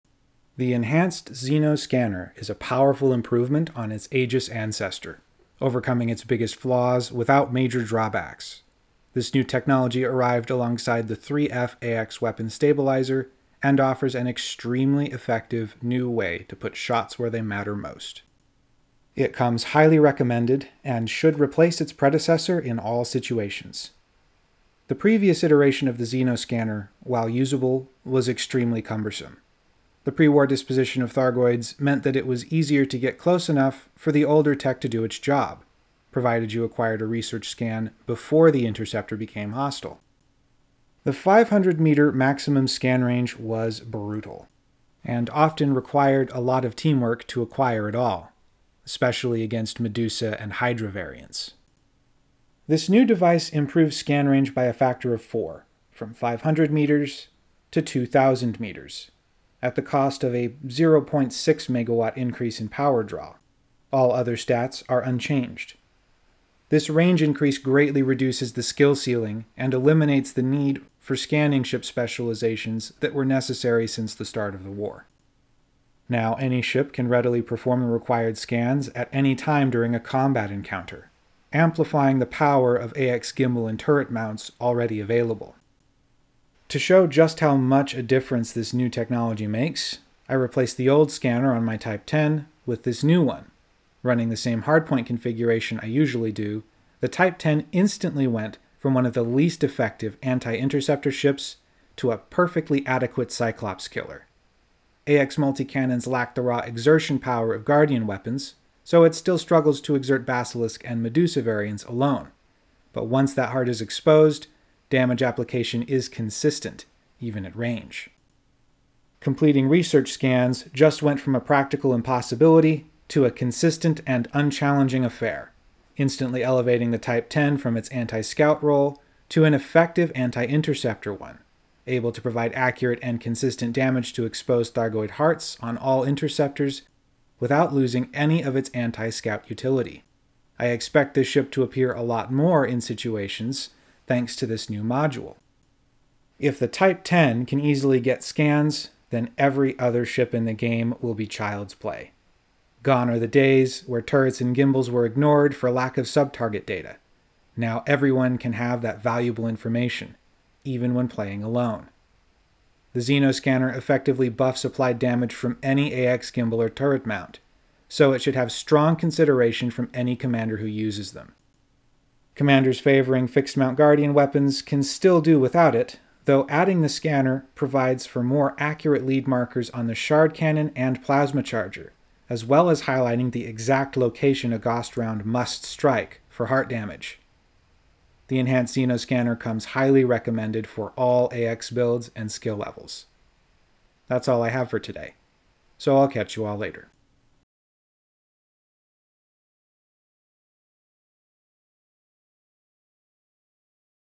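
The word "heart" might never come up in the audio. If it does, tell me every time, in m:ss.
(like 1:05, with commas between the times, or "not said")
1:53, 2:15, 3:06.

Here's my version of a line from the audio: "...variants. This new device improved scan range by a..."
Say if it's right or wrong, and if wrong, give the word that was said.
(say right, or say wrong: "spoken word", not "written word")
right.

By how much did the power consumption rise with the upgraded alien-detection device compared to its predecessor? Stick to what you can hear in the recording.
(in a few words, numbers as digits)
0.6 megawatts.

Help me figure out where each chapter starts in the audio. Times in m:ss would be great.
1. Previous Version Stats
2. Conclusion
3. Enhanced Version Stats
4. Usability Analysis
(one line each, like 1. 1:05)
1. 0:25
2. 3:07
3. 0:50
4. 1:18.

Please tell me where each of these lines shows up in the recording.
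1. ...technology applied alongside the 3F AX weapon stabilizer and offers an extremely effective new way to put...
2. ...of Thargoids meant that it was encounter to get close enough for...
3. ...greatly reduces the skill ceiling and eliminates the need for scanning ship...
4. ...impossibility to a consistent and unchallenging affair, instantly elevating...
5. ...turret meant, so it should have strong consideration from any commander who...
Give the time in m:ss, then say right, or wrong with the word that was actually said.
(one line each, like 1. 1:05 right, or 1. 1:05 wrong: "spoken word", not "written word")
1. 0:09 wrong: "arrived", not "applied"
2. 0:31 wrong: "easier", not "encounter"
3. 1:07 right
4. 2:01 right
5. 2:46 wrong: "mount", not "meant".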